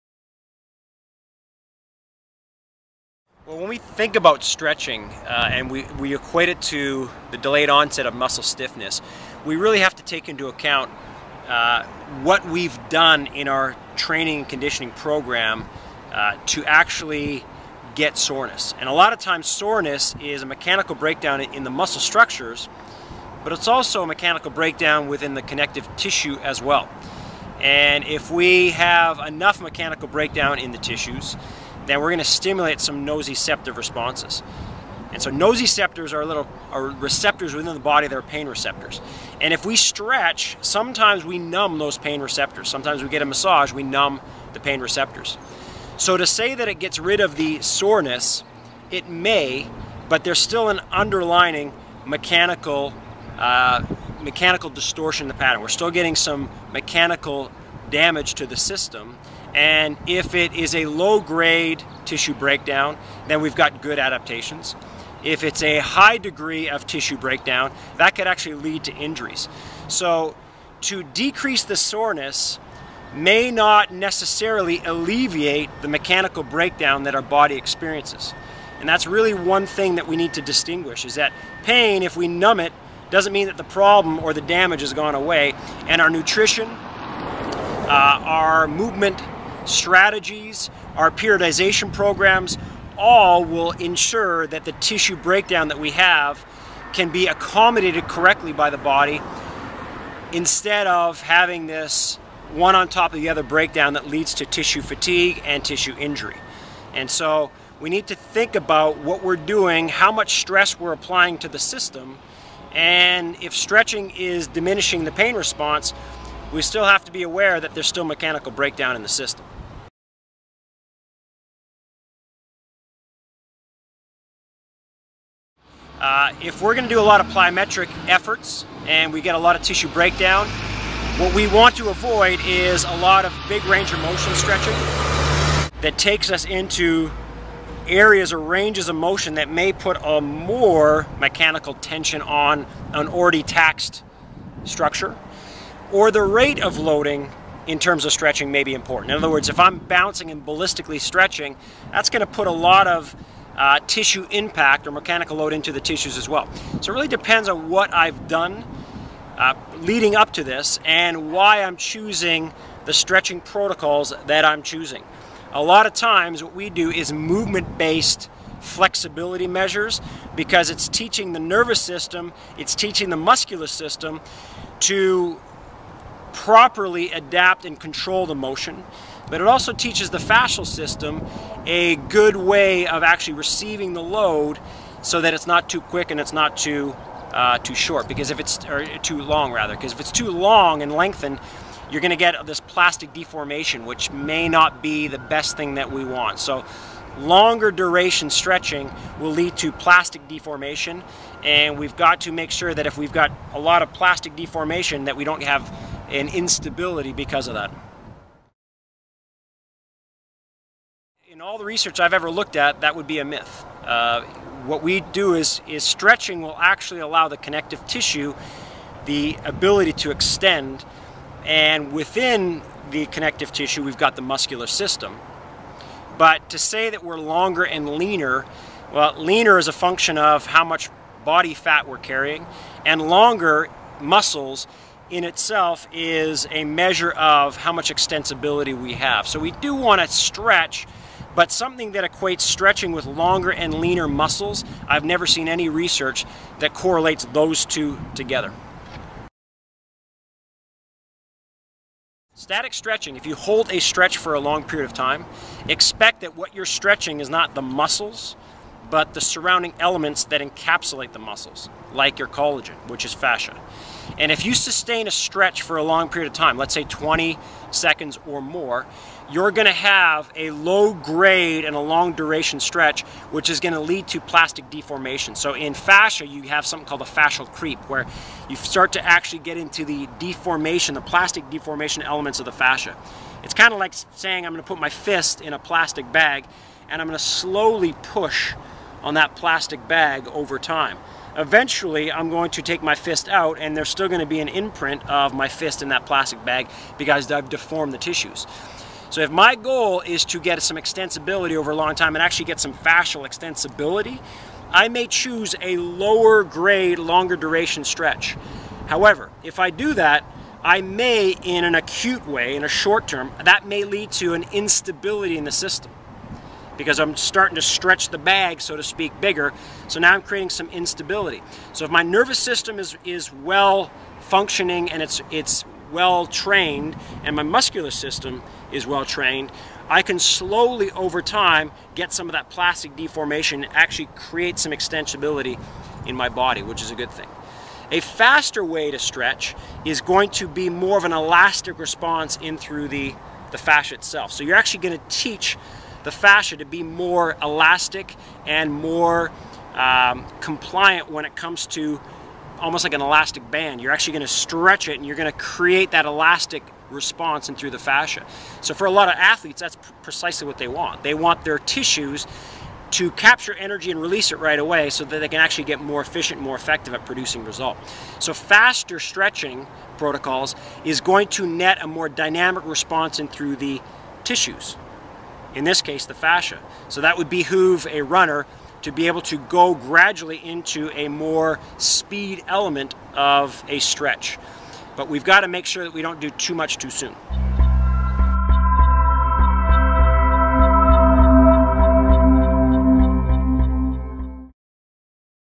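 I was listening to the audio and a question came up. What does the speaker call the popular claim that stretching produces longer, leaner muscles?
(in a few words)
A myth.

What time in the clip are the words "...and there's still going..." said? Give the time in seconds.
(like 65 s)
293 s.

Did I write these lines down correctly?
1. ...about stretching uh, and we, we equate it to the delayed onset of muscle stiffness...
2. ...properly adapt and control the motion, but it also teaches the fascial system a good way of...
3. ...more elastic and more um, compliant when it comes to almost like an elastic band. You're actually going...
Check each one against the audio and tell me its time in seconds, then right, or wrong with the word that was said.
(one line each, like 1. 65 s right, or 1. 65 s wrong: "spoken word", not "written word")
1. 4 s right
2. 176 s right
3. 346 s right.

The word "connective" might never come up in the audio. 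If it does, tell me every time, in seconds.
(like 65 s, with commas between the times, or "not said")
25 s, 217 s, 223 s.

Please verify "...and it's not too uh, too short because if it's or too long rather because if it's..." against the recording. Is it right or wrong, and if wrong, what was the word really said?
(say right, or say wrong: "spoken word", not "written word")
right.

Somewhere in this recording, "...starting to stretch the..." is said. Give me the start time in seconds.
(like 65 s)
317 s.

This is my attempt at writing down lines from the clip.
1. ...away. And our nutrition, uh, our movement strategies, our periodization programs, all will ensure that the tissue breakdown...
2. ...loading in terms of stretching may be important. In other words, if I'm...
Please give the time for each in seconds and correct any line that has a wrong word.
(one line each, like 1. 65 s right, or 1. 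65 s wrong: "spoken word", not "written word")
1. 85 s right
2. 146 s right.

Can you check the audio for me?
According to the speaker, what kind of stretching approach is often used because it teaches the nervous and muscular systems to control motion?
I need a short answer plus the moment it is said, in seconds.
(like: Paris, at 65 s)
Movement-based flexibility, at 167 s.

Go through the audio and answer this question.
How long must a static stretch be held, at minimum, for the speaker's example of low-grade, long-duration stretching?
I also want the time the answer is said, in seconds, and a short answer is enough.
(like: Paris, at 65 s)
20 seconds, at 266 s.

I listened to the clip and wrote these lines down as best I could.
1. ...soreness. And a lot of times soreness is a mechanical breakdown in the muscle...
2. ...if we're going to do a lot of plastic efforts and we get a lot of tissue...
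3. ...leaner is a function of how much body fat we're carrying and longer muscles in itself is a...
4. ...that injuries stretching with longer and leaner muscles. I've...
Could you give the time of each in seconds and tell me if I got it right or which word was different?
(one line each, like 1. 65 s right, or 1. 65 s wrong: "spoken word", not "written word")
1. 18 s right
2. 126 s wrong: "plyometric", not "plastic"
3. 229 s right
4. 241 s wrong: "equates", not "injuries".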